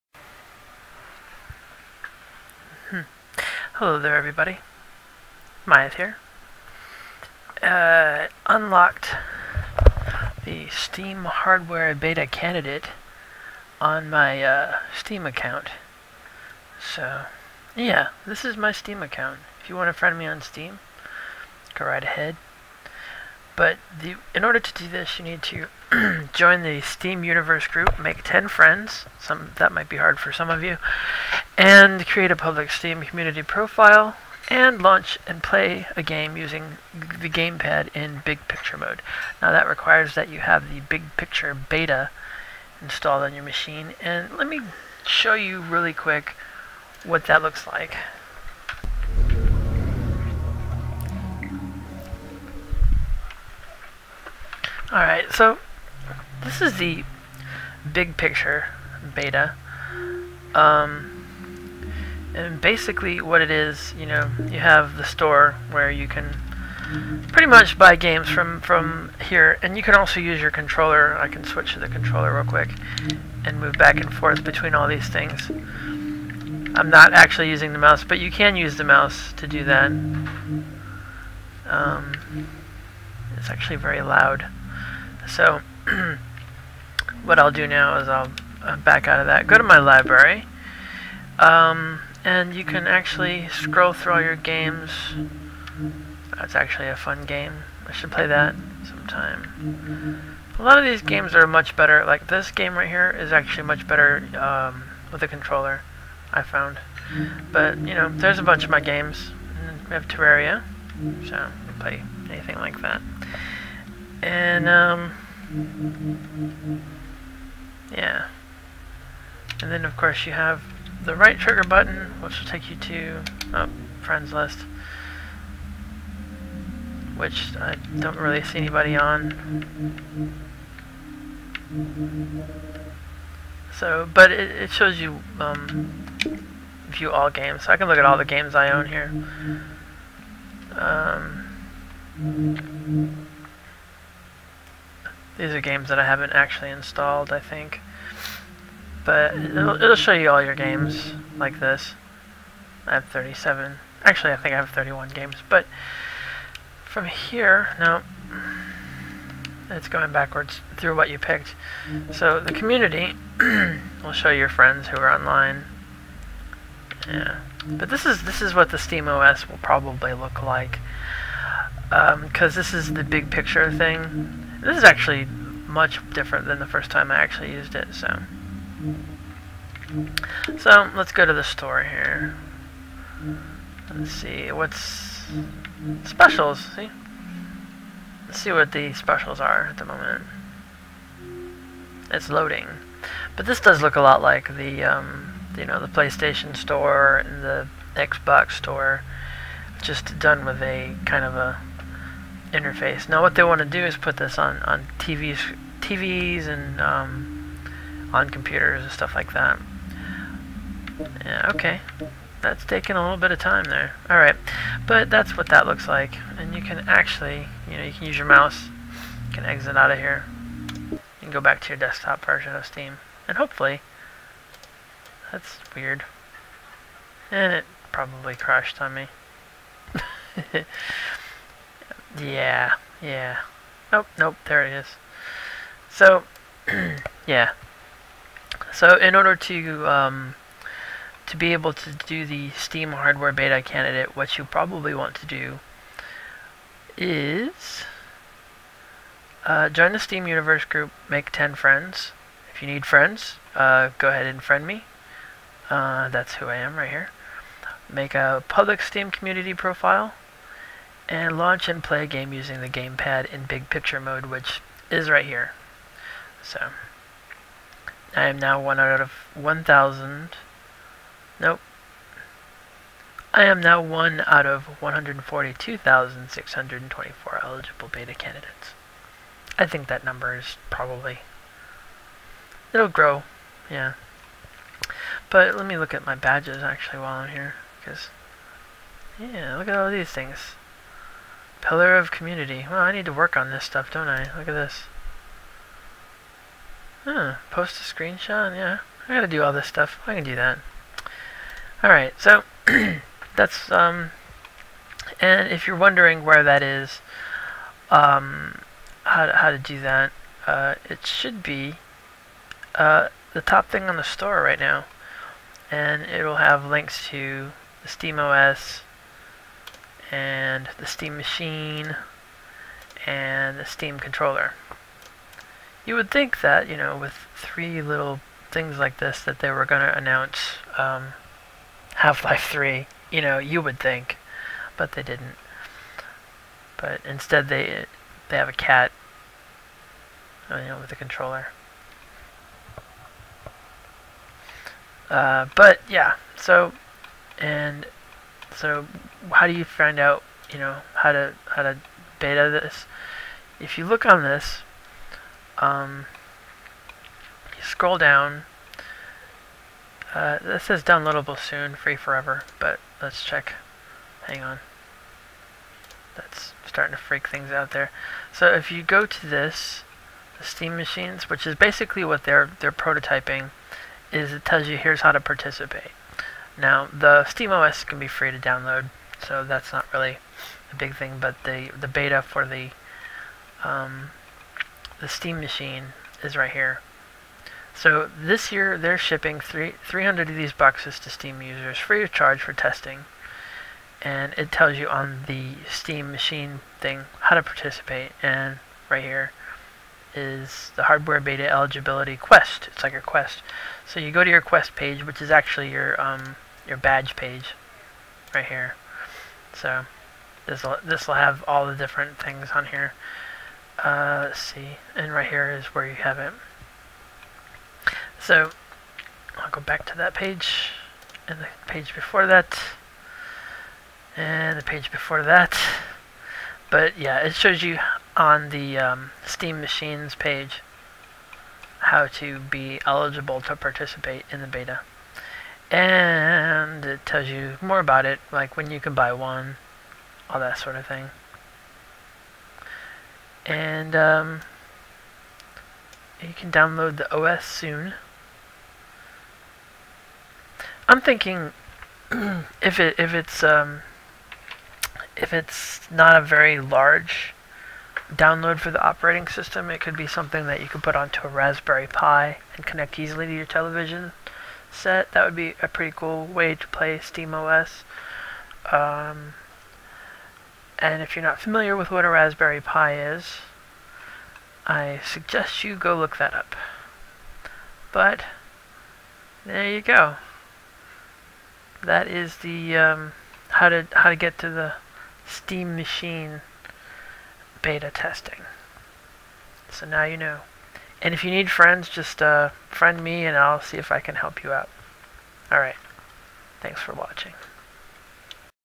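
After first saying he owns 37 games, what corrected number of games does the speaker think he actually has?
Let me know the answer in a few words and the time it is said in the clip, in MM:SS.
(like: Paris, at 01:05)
31, at 02:34.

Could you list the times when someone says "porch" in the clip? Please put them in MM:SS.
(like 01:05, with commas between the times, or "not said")
not said.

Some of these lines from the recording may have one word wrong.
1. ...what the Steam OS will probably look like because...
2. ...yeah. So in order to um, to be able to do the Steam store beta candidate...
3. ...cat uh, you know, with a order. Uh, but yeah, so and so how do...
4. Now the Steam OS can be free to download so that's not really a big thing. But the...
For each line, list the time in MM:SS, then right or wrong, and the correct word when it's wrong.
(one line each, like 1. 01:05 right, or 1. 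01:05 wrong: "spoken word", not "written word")
1. 02:48 right
2. 03:57 wrong: "hardware", not "store"
3. 05:38 wrong: "controller", not "order"
4. 06:16 right.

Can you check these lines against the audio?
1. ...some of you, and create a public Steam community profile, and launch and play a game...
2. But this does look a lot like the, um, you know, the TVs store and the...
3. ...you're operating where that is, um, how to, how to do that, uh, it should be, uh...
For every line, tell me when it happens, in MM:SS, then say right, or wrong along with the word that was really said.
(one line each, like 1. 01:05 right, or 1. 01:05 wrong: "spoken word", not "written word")
1. 00:30 right
2. 03:13 wrong: "PlayStation", not "TVs"
3. 05:05 wrong: "wondering", not "operating".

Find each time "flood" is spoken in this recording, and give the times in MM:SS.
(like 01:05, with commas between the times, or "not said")
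not said.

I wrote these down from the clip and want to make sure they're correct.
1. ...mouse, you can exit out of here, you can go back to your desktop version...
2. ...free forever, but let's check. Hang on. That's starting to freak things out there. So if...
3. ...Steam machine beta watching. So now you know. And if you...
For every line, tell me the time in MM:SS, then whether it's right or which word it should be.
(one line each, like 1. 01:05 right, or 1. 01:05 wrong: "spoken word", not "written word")
1. 03:38 right
2. 06:01 right
3. 08:05 wrong: "testing", not "watching".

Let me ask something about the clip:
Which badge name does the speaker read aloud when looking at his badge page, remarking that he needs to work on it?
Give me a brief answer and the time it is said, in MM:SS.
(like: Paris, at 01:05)
Pillar of community, at 04:51.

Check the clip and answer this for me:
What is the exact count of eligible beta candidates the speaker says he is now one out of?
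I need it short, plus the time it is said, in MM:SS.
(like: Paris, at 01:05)
142,624, at 04:34.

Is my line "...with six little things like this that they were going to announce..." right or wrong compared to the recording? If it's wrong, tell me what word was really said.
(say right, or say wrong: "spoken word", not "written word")
wrong: "three", not "six".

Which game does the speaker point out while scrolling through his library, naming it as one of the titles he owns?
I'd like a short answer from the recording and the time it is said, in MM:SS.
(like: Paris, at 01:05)
Terraria, at 01:50.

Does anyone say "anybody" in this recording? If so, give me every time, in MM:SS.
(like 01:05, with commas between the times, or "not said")
02:08.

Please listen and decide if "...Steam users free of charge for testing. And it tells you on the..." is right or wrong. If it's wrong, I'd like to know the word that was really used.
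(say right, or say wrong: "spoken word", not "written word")
right.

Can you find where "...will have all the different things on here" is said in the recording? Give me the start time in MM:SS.
06:51.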